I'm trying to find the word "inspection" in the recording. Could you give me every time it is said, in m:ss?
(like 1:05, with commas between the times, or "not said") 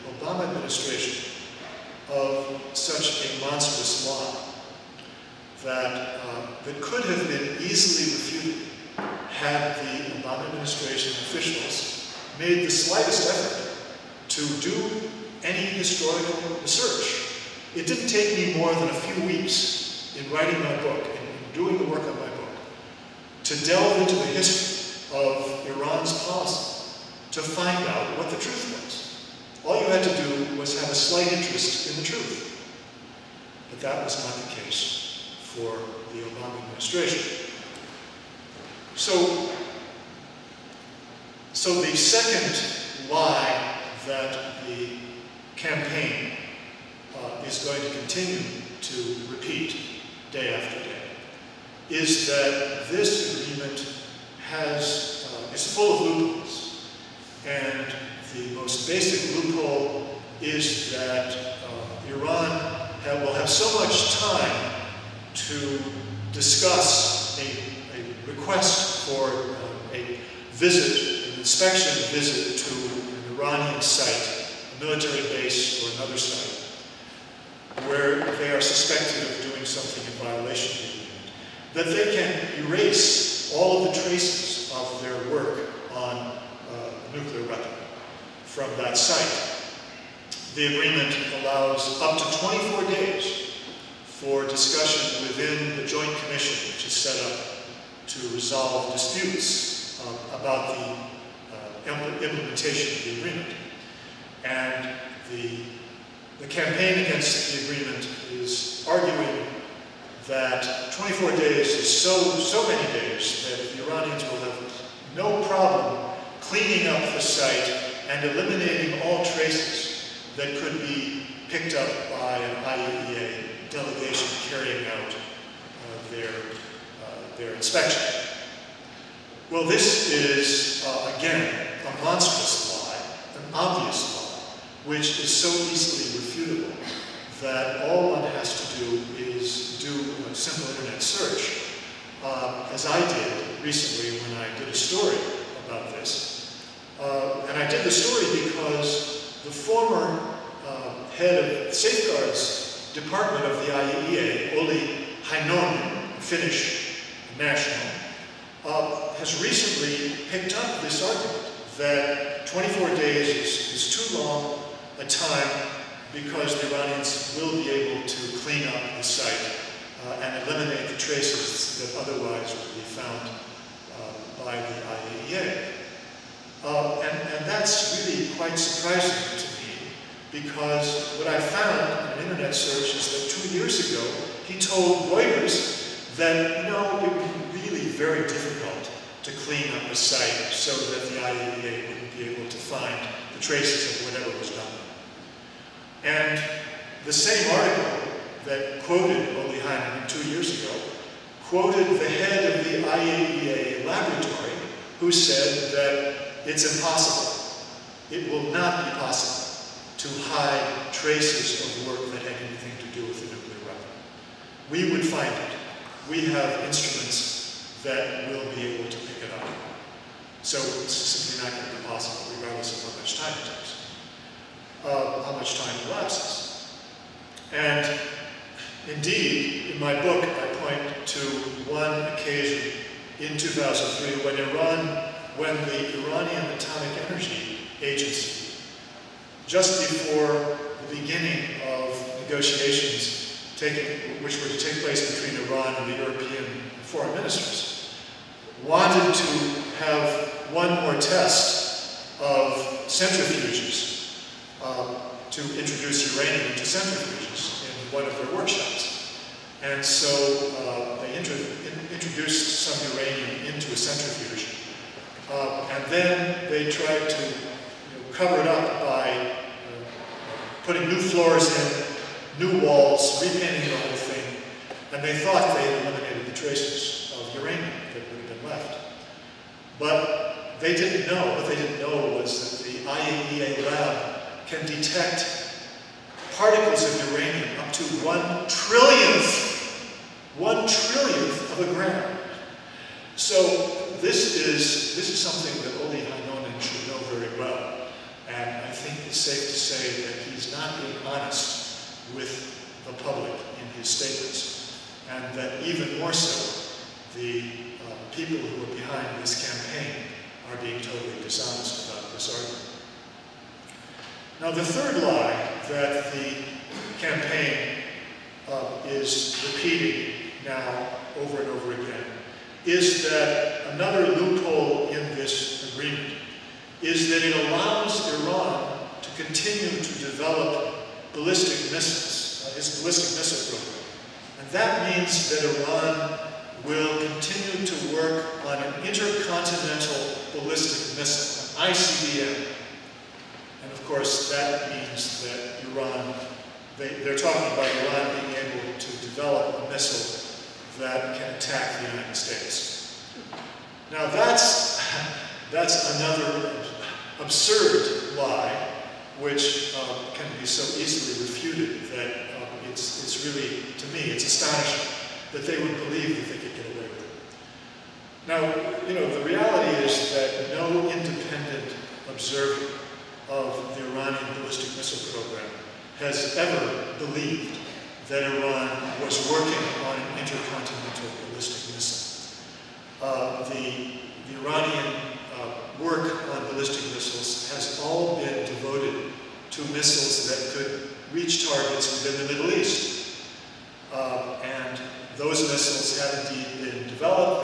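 1:11, 2:07.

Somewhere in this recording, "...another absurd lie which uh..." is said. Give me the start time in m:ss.
5:55.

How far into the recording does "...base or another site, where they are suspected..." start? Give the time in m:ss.
1:15.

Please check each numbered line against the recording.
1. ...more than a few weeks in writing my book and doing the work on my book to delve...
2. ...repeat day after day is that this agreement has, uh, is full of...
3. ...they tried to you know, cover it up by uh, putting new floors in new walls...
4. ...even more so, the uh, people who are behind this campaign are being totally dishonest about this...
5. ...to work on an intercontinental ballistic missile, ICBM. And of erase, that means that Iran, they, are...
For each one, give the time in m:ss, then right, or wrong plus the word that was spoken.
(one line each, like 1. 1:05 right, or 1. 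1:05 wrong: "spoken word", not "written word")
1. 0:18 right
2. 0:49 right
3. 4:26 right
4. 5:05 right
5. 5:37 wrong: "course", not "erase".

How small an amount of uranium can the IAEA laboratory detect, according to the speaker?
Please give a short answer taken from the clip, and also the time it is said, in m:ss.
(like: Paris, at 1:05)
one trillionth of a gram, at 4:50.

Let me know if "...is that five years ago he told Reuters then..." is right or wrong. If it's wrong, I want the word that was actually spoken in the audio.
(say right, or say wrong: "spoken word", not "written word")
wrong: "two", not "five".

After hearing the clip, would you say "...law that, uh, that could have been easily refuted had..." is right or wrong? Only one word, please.
right.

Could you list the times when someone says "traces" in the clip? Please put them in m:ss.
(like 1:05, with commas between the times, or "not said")
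1:24, 1:59, 2:50, 3:13, 3:30, 4:36.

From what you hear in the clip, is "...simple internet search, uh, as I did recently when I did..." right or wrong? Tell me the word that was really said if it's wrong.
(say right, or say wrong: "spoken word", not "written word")
right.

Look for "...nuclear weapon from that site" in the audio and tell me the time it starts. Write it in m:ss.
1:27.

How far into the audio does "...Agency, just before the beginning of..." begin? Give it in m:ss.
3:57.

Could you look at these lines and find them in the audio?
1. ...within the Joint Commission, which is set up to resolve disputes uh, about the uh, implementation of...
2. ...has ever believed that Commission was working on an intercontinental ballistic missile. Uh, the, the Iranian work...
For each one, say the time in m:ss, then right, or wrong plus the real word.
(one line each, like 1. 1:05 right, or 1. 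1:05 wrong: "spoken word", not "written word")
1. 1:35 right
2. 6:15 wrong: "Iran", not "Commission".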